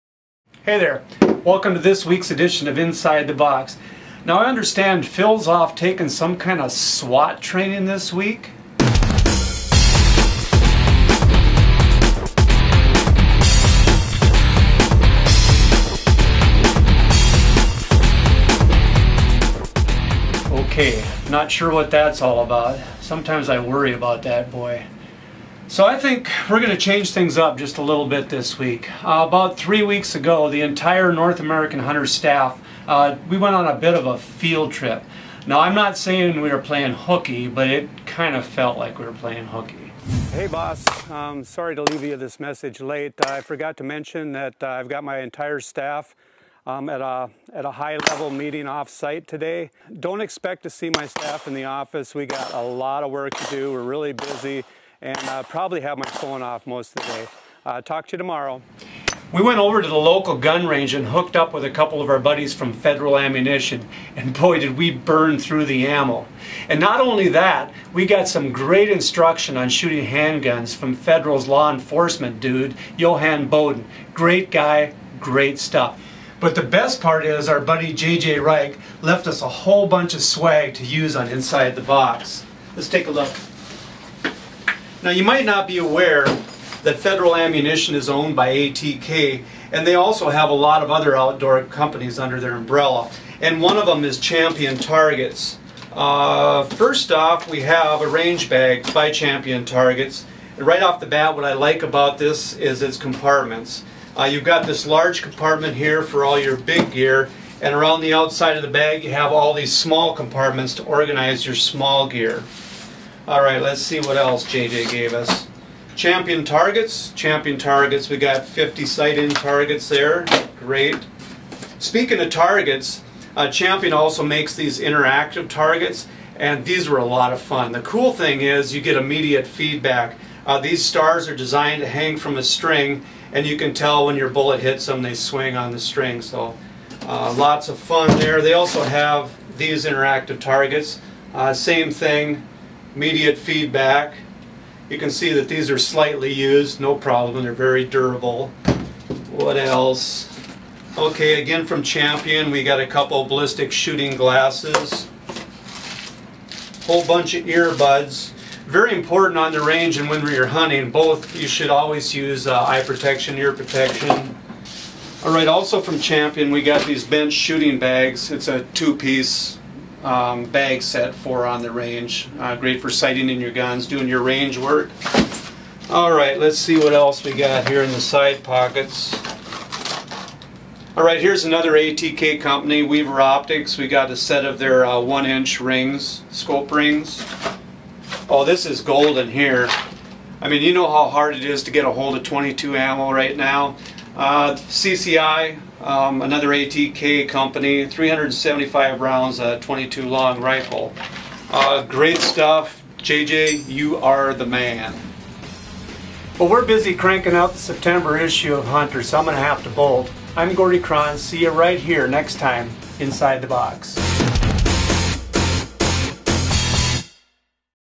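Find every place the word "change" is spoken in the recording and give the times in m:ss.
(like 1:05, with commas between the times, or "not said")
0:26.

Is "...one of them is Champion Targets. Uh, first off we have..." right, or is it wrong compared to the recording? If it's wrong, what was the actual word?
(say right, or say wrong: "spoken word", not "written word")
right.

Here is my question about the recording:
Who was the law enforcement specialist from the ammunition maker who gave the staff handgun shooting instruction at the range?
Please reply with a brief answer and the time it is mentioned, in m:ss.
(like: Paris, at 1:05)
Johan Bowden, at 1:12.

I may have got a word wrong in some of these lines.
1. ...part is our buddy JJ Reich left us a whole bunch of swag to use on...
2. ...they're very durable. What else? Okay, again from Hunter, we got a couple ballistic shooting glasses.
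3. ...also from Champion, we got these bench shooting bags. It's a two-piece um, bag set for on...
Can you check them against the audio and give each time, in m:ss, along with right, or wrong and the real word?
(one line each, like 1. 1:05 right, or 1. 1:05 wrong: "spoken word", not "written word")
1. 1:17 right
2. 2:27 wrong: "Champion", not "Hunter"
3. 2:45 right.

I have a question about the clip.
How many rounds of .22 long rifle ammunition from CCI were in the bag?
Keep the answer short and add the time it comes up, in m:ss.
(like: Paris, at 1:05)
375, at 3:17.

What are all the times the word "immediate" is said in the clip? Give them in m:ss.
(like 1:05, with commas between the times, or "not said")
2:08, 2:22.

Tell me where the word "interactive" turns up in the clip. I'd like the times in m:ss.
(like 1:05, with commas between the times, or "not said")
2:04, 2:19.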